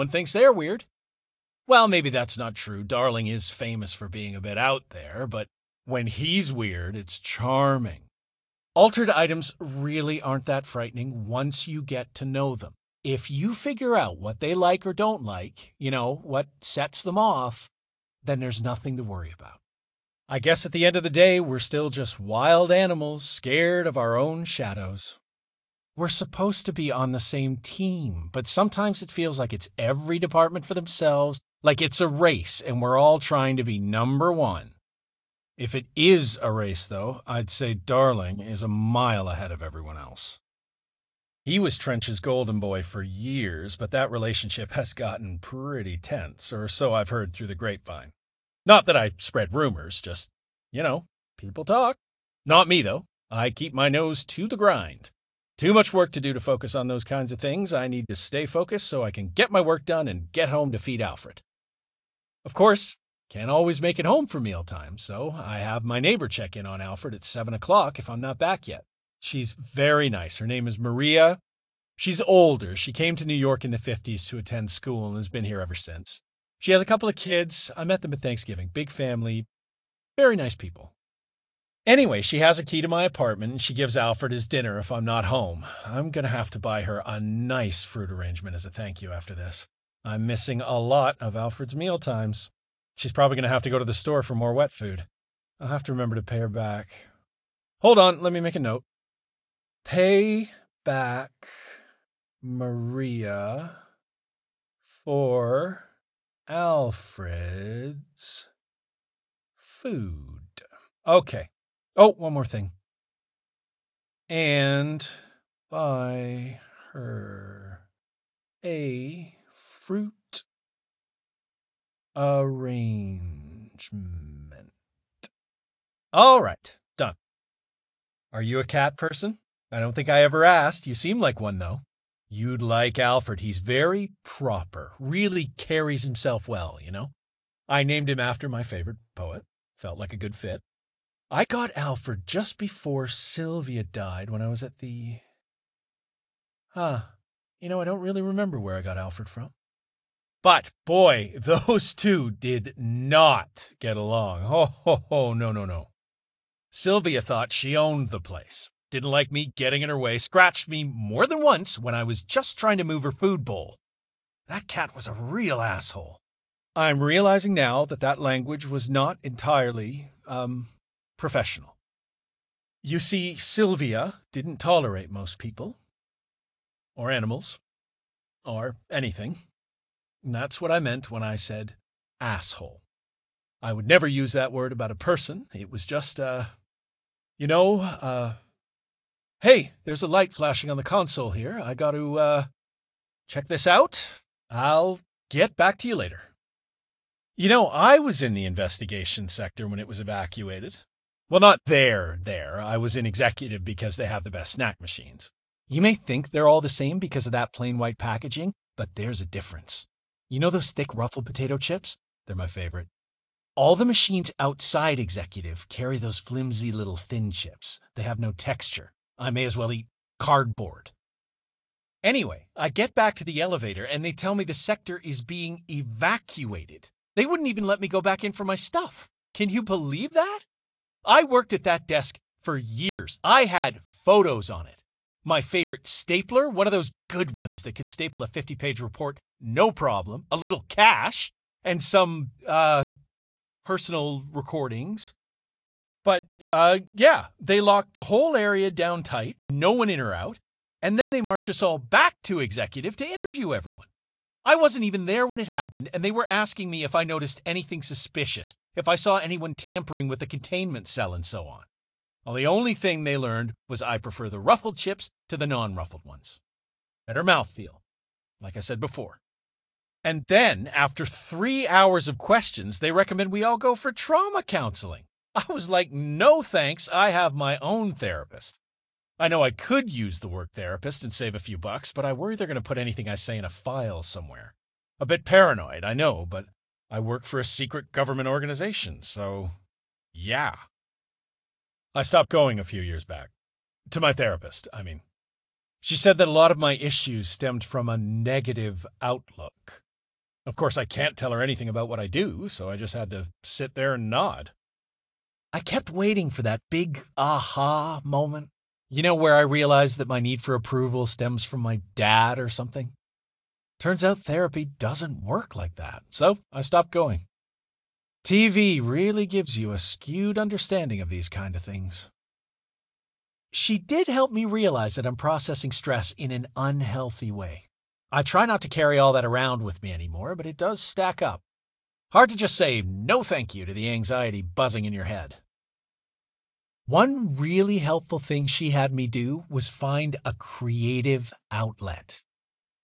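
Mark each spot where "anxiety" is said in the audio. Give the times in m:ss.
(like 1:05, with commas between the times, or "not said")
5:33.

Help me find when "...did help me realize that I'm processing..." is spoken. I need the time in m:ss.
5:23.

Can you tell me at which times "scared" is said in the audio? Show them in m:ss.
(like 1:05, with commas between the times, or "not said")
0:23.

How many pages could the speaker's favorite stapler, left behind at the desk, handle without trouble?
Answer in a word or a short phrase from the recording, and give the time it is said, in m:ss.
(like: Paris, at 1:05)
50, at 3:58.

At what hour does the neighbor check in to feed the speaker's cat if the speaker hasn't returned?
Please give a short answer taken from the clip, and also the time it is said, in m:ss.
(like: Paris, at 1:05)
7 o'clock, at 1:07.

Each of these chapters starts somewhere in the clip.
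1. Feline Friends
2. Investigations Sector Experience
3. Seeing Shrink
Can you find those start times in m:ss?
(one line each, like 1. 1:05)
1. 1:01
2. 3:16
3. 4:29.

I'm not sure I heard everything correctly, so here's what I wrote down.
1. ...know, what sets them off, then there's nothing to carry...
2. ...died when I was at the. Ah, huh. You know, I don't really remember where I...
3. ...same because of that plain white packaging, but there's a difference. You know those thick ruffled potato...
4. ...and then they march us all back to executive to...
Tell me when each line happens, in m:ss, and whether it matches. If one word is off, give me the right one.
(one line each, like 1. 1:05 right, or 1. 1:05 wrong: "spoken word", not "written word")
1. 0:15 wrong: "worry", not "carry"
2. 2:23 right
3. 3:26 right
4. 4:10 right.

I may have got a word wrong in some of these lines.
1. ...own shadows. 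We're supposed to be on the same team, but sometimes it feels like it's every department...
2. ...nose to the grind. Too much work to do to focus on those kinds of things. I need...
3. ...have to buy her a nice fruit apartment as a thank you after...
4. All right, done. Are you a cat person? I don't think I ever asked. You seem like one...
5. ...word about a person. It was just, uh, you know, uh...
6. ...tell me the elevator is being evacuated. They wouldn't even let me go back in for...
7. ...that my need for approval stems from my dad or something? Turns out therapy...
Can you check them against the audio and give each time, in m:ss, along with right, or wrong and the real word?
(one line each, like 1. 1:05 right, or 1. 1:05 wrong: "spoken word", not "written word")
1. 0:24 right
2. 0:53 right
3. 1:26 wrong: "arrangement", not "apartment"
4. 2:06 right
5. 3:04 right
6. 3:44 wrong: "sector", not "elevator"
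7. 5:09 right.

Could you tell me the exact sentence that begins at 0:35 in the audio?
If it is a race, though, I'd say Darling is a mile ahead of everyone else.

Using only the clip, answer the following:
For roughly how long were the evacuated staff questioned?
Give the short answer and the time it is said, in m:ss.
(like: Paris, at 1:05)
3 hours, at 4:31.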